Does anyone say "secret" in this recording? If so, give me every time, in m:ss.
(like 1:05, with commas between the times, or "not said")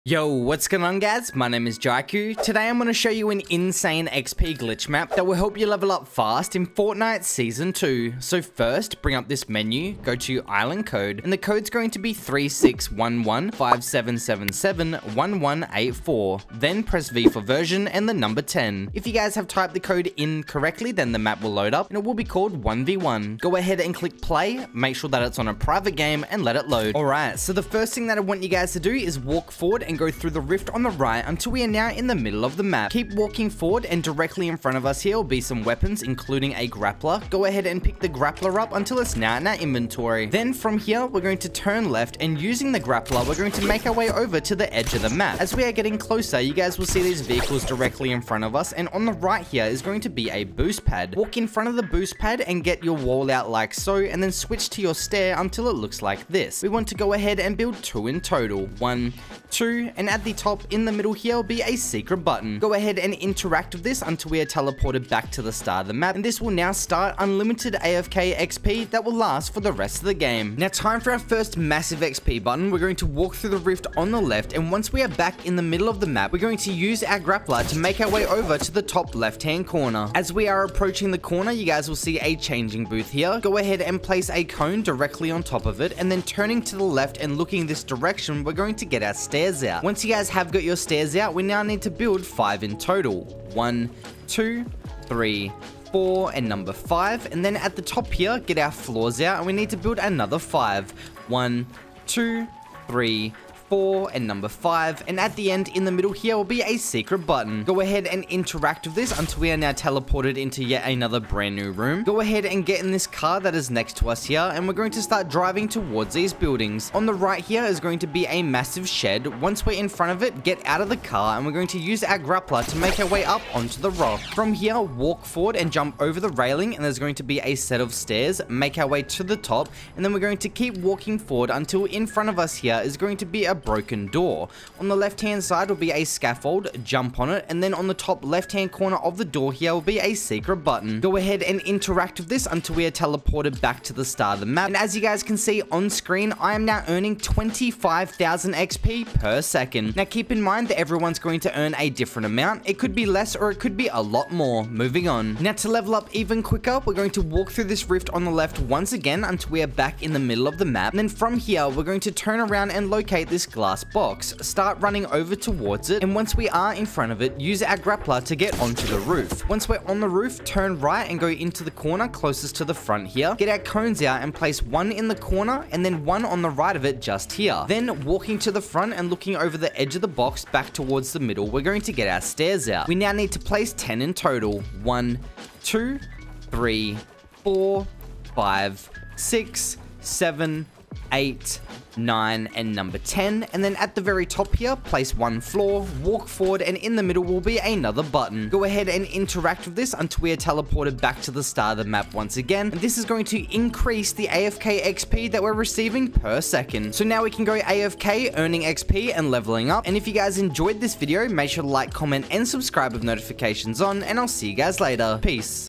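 1:01, 1:46, 2:20.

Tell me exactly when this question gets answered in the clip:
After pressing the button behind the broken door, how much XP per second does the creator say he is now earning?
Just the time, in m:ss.
2:27.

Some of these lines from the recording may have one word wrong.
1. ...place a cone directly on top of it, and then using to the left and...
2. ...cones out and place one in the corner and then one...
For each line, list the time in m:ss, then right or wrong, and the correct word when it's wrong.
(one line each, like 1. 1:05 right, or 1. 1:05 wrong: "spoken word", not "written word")
1. 1:24 wrong: "turning", not "using"
2. 2:53 right.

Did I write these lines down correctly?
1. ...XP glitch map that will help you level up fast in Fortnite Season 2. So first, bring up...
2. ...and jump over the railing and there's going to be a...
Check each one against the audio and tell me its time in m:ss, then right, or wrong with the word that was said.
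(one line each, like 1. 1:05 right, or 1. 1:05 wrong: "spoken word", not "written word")
1. 0:04 right
2. 2:05 right.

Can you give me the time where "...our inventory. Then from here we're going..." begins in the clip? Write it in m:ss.
0:39.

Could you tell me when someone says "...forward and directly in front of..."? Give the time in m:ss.
0:33.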